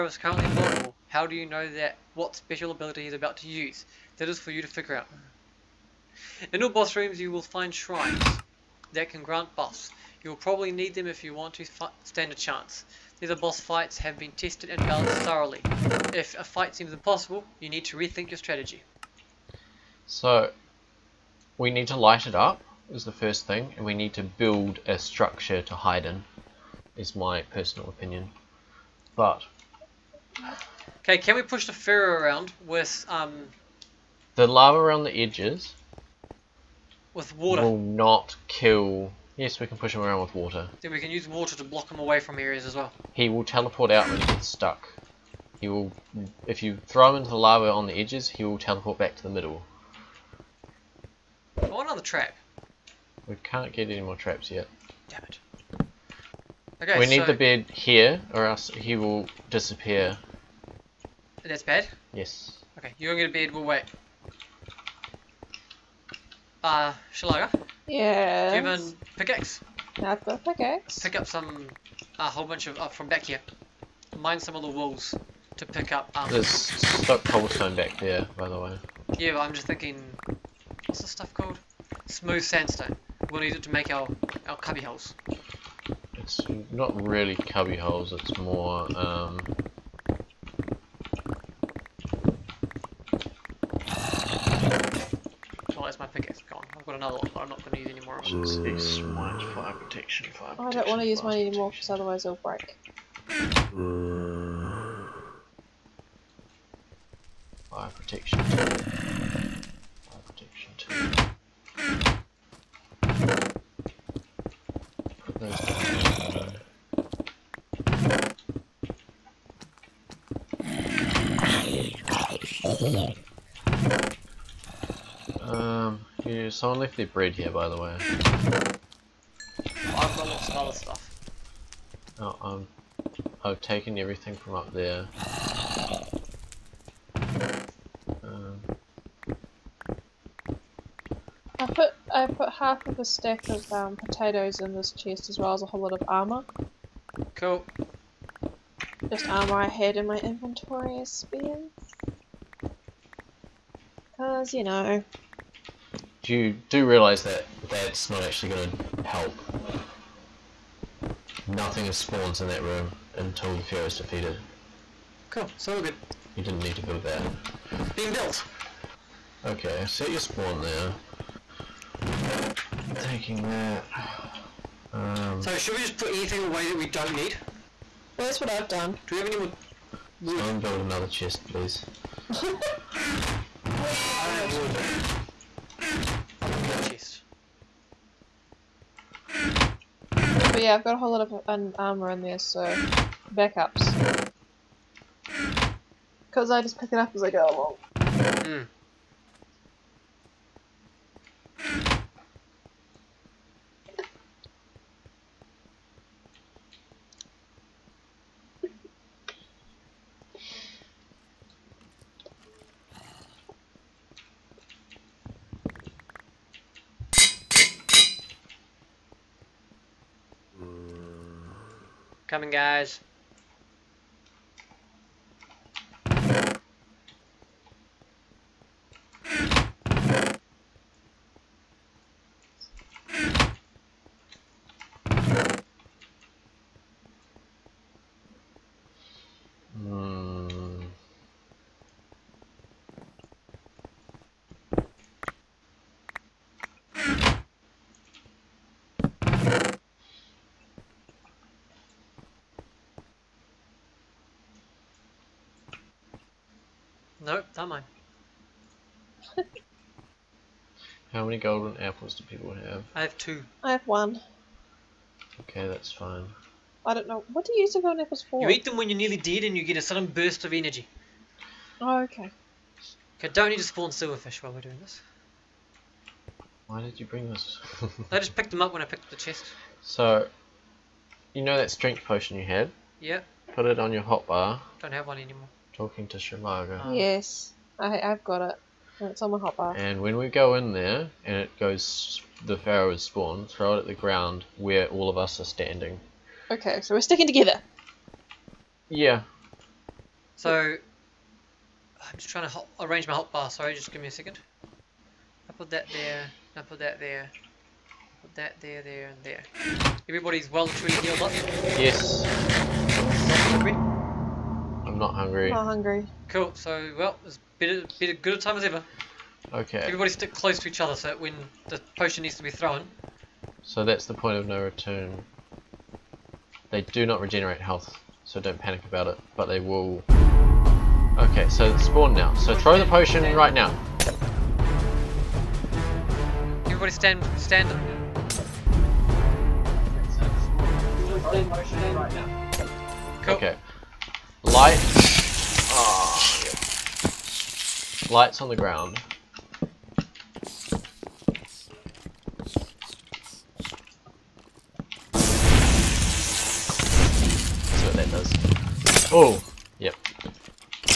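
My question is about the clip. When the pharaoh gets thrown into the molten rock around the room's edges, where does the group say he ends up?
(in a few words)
the middle.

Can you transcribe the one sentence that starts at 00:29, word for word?
But Okay, can we push the pharaoh around with um?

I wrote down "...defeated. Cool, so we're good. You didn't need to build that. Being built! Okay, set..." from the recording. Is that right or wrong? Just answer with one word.
right.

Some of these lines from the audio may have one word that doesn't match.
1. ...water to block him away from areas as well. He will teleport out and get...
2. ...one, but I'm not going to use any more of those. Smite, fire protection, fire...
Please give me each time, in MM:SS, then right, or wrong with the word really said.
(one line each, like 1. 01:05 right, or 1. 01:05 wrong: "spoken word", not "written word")
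1. 00:41 right
2. 01:37 right.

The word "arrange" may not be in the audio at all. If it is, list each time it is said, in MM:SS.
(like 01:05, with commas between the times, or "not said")
05:02.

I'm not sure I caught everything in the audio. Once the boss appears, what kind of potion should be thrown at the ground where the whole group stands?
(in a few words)
strength.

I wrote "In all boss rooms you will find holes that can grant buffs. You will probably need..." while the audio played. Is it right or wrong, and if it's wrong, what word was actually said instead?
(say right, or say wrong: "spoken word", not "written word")
wrong: "shrines", not "holes".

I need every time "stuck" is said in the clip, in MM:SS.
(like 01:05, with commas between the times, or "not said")
00:44, 01:16.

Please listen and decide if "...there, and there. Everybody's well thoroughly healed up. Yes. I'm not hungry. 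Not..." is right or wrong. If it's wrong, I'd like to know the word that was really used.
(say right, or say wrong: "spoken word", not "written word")
wrong: "truly", not "thoroughly".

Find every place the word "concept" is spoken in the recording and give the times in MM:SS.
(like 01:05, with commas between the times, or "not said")
not said.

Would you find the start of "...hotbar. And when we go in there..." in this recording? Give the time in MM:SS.
04:49.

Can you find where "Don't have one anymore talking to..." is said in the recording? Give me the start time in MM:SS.
04:44.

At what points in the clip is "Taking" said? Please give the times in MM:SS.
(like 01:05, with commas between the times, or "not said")
02:53.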